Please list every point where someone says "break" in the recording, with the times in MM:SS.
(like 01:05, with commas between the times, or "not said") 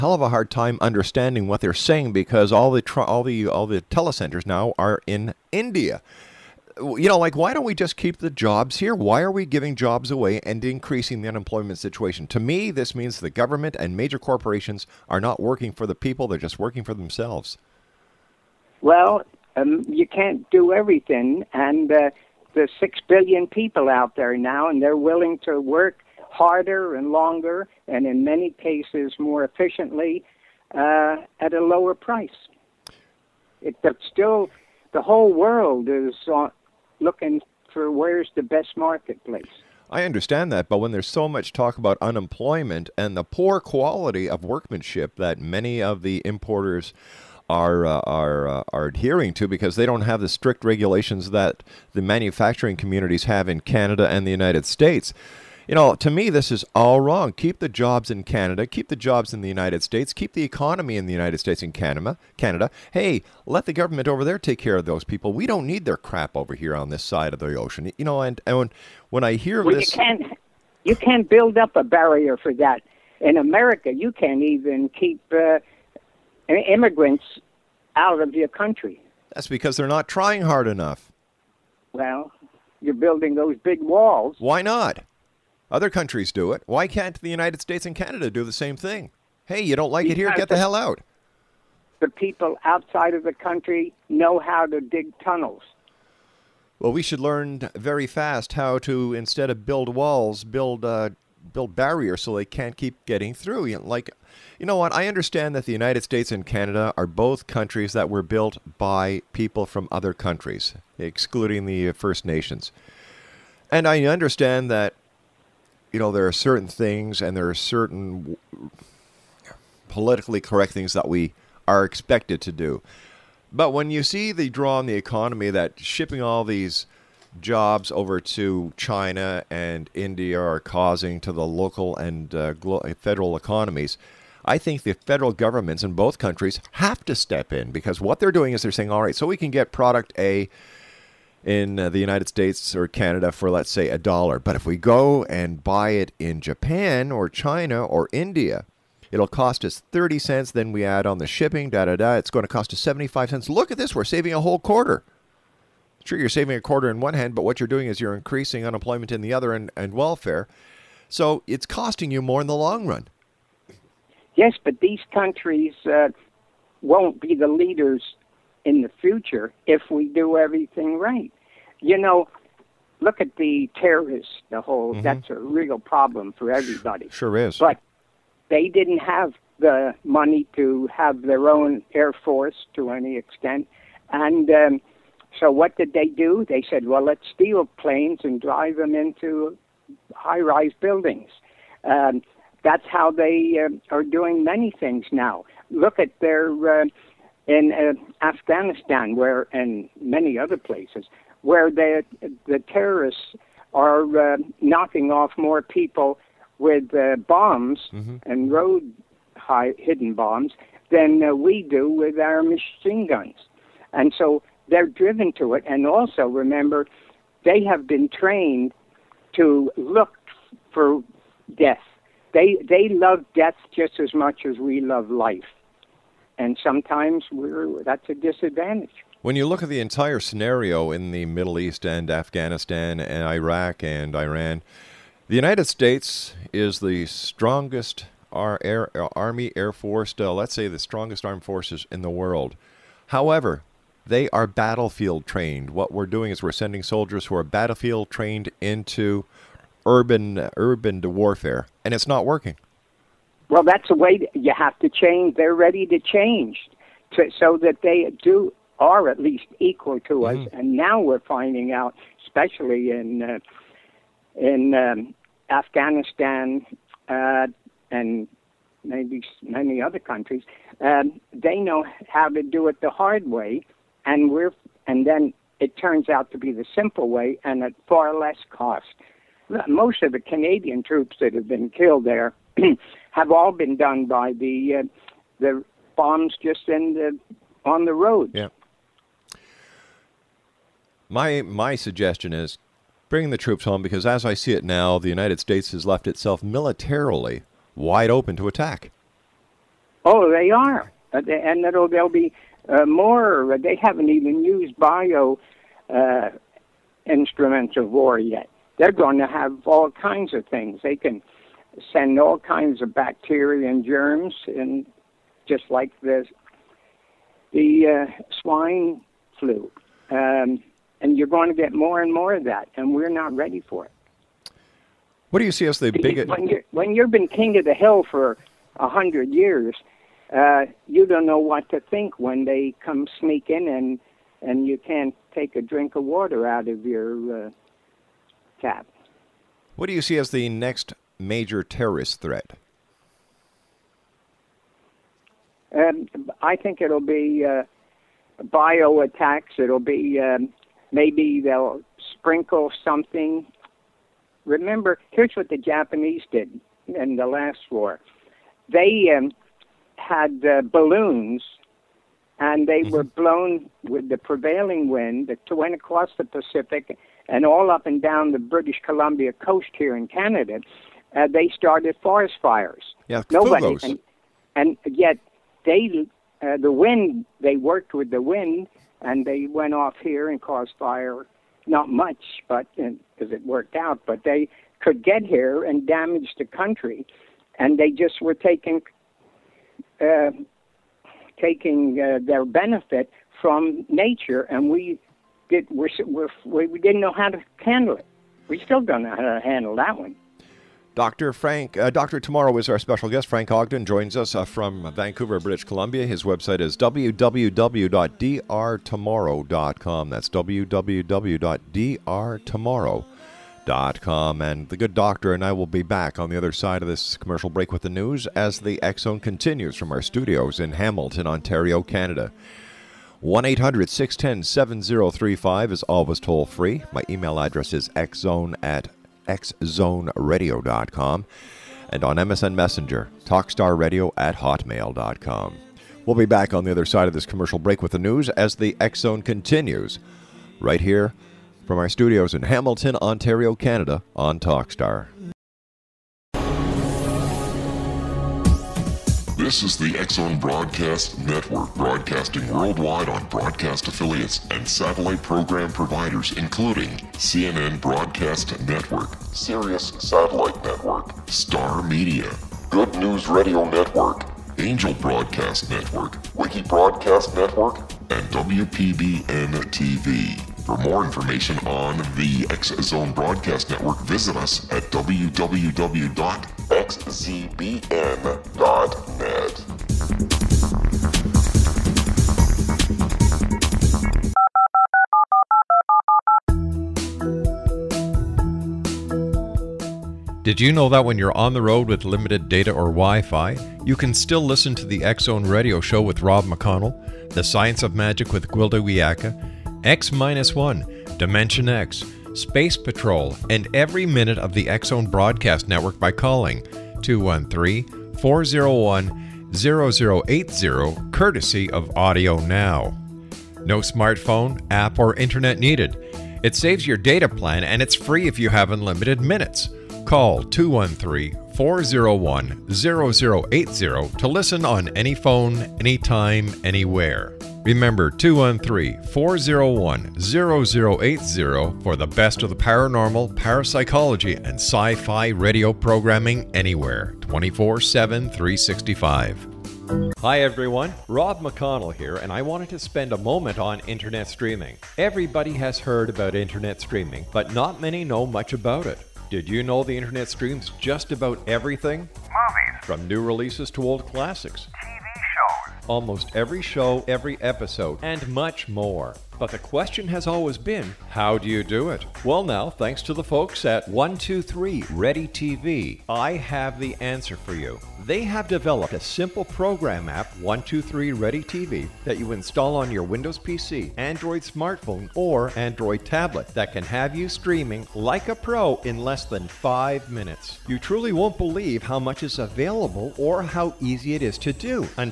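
06:57, 07:17.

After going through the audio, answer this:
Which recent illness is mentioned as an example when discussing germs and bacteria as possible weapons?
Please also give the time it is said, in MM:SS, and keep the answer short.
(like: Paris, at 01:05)
swine flu, at 05:18.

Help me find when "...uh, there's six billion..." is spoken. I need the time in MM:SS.
00:21.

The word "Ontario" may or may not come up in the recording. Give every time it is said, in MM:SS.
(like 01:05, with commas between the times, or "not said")
07:01, 07:22.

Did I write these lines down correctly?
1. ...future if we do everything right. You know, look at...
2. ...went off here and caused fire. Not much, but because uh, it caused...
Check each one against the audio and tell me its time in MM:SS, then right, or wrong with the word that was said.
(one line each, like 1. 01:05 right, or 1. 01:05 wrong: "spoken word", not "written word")
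1. 02:49 right
2. 06:19 wrong: "worked", not "caused".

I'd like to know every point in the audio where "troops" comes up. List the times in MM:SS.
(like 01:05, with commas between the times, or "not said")
04:40, 04:53.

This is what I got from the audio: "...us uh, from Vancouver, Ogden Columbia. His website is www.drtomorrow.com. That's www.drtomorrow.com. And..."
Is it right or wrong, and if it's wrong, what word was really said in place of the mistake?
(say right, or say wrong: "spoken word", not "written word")
wrong: "British", not "Ogden".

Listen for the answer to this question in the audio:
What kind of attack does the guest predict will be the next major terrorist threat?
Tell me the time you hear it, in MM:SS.
05:48.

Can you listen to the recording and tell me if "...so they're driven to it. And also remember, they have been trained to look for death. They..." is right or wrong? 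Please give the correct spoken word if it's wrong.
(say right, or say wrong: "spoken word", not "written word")
right.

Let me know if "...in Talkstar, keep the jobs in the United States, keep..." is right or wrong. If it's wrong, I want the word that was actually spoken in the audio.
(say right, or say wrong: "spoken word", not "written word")
wrong: "Canada", not "Talkstar".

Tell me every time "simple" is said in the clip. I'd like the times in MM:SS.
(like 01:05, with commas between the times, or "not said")
04:36, 09:28.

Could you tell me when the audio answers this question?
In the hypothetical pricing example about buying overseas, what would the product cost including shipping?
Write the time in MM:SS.
02:32.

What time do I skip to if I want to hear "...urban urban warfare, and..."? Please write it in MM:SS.
04:09.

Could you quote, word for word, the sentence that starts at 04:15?
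They're ready to change to, so that they do are at least equal to mm-hmm.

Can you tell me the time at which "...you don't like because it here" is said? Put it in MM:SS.
01:29.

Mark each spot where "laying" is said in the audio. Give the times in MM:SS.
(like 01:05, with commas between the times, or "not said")
not said.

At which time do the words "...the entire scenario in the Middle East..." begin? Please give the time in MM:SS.
03:49.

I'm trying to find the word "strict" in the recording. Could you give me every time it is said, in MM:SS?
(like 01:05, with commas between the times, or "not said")
00:50.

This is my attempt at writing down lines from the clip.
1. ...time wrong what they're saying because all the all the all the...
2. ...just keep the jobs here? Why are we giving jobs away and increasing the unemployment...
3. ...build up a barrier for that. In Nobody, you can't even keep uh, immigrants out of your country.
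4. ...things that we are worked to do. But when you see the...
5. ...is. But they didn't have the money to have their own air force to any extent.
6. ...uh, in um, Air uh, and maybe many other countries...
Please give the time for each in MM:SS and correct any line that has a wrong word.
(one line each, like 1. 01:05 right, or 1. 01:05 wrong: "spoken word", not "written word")
1. 00:00 wrong: "understanding", not "wrong"
2. 00:07 right
3. 01:11 wrong: "America", not "Nobody"
4. 02:00 wrong: "expected", not "worked"
5. 02:57 right
6. 04:23 wrong: "Afghanistan", not "Air".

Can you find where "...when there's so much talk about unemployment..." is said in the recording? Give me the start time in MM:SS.
00:40.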